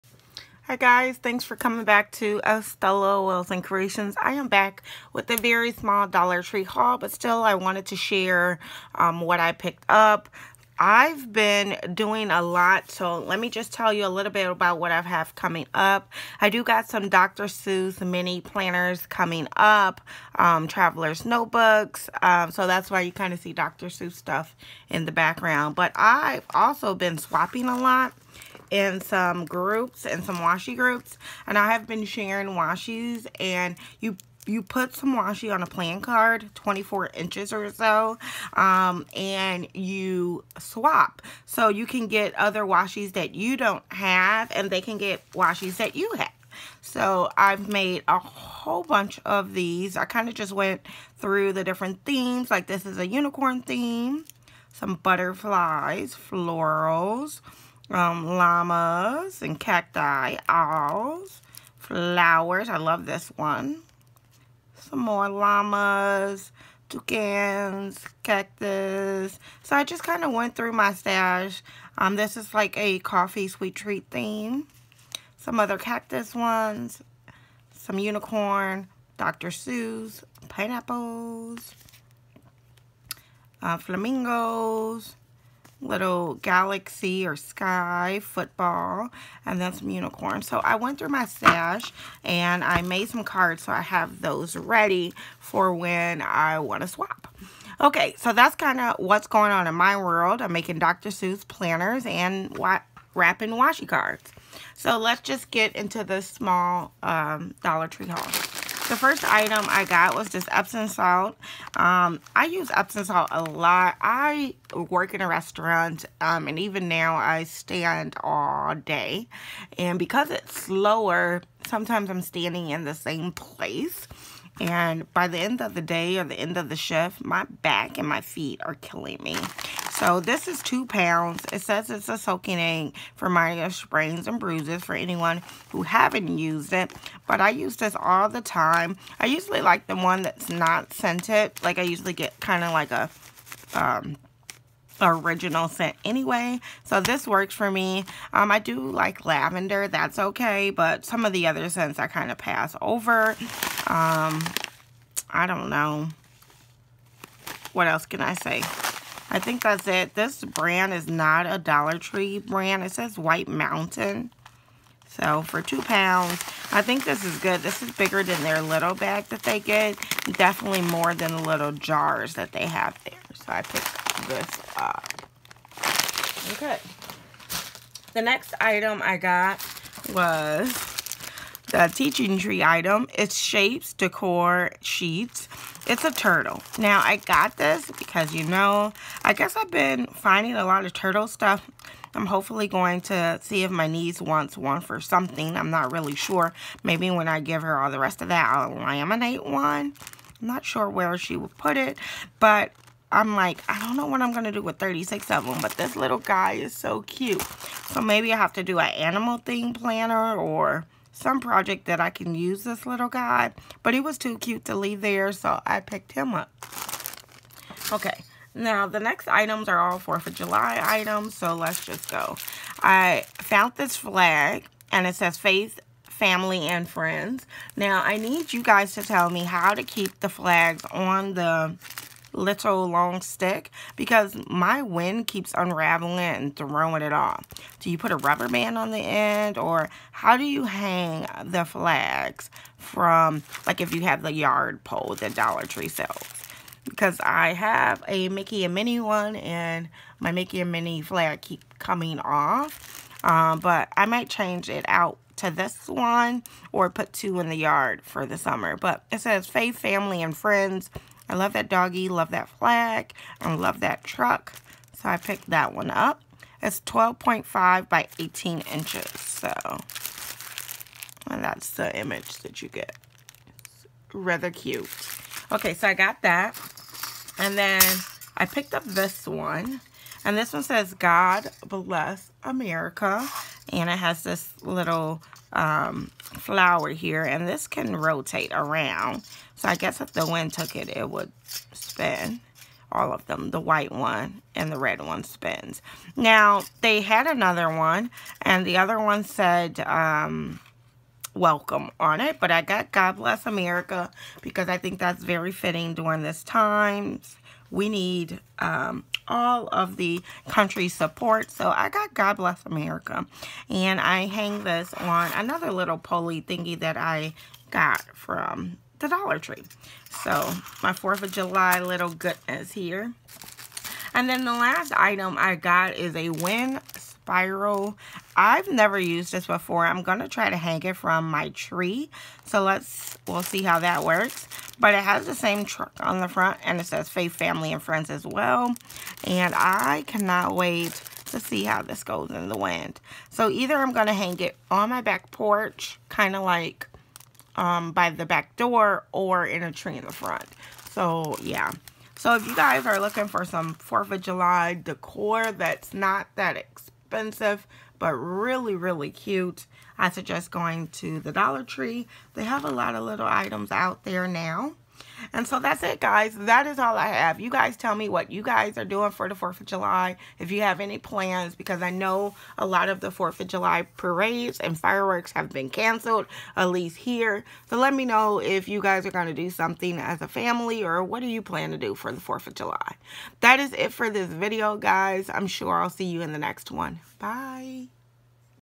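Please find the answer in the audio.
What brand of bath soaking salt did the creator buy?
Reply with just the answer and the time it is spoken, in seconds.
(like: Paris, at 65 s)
White Mountain, at 163 s.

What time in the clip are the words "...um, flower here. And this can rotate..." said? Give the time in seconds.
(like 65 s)
285 s.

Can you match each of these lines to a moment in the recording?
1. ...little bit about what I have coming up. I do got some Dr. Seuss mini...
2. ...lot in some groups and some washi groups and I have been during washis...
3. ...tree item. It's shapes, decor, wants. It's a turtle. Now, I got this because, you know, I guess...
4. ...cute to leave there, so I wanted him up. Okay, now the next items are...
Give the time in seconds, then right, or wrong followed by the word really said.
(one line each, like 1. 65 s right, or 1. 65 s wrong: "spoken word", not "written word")
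1. 14 s right
2. 27 s wrong: "sharing", not "during"
3. 182 s wrong: "sheets", not "wants"
4. 214 s wrong: "picked", not "wanted".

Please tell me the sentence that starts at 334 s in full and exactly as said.
But it has the same truck on the front and it says Faith, Family, and Friends as well.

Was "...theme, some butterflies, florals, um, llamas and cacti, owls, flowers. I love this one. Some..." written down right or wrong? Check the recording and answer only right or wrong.
right.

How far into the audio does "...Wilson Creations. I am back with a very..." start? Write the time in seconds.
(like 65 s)
3 s.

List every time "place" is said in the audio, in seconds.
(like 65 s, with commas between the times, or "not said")
123 s.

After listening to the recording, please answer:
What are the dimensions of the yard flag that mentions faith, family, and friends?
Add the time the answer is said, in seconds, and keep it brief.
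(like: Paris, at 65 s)
12.5 by 18 inches, at 266 s.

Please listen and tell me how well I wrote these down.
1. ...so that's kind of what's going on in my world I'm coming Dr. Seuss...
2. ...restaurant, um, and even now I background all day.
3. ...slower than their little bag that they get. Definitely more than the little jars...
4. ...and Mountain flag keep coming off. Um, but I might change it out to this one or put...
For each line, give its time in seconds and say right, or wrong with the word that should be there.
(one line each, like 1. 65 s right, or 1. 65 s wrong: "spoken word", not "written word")
1. 98 s wrong: "making", not "coming"
2. 115 s wrong: "stand", not "background"
3. 167 s wrong: "bigger", not "slower"
4. 250 s wrong: "Minnie", not "Mountain".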